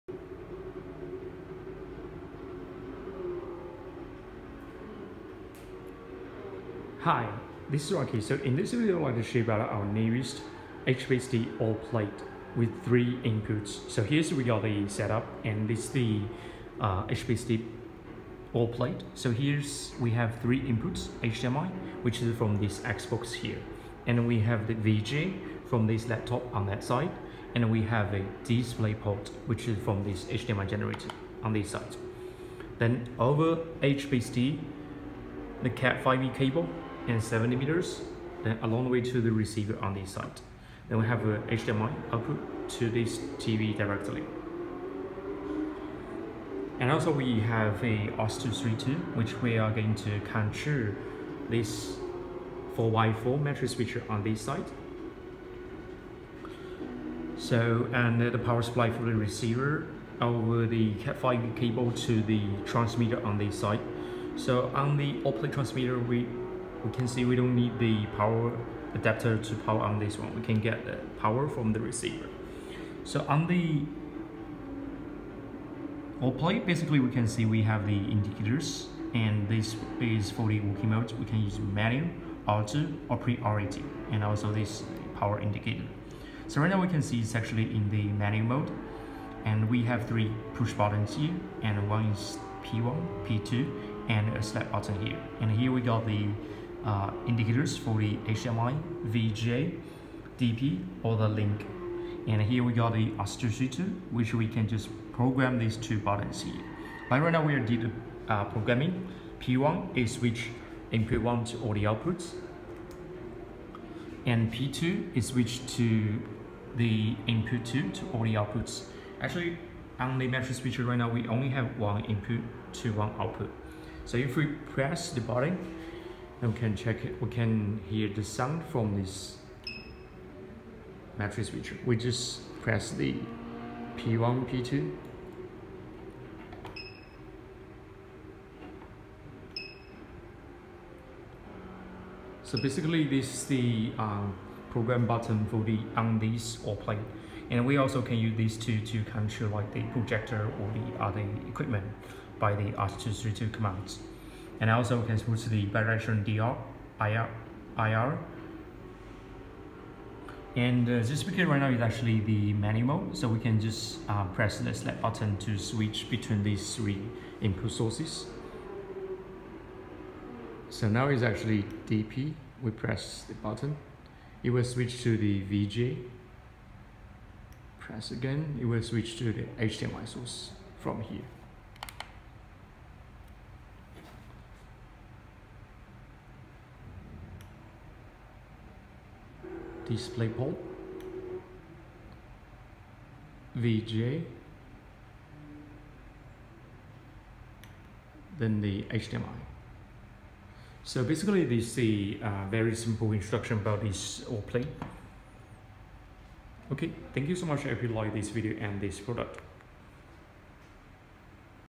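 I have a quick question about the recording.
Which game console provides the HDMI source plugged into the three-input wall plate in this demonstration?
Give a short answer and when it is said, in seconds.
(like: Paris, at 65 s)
Xbox, at 22 s.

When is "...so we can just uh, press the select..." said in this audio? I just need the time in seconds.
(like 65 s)
163 s.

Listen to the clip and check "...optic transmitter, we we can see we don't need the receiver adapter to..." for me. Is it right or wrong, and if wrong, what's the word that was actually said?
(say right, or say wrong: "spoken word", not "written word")
wrong: "power", not "receiver".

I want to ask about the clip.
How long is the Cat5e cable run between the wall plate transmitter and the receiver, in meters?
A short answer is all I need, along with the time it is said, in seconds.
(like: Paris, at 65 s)
70 meters, at 37 s.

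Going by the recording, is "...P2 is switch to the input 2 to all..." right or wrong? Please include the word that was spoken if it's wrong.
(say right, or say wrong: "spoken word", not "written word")
right.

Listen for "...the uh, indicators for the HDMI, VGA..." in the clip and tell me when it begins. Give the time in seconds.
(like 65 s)
96 s.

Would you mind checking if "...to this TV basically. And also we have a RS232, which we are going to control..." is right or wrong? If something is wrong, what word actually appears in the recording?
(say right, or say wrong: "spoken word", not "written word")
wrong: "directly", not "basically".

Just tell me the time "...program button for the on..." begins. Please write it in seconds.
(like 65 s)
144 s.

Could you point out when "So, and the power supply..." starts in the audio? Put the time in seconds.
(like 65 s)
57 s.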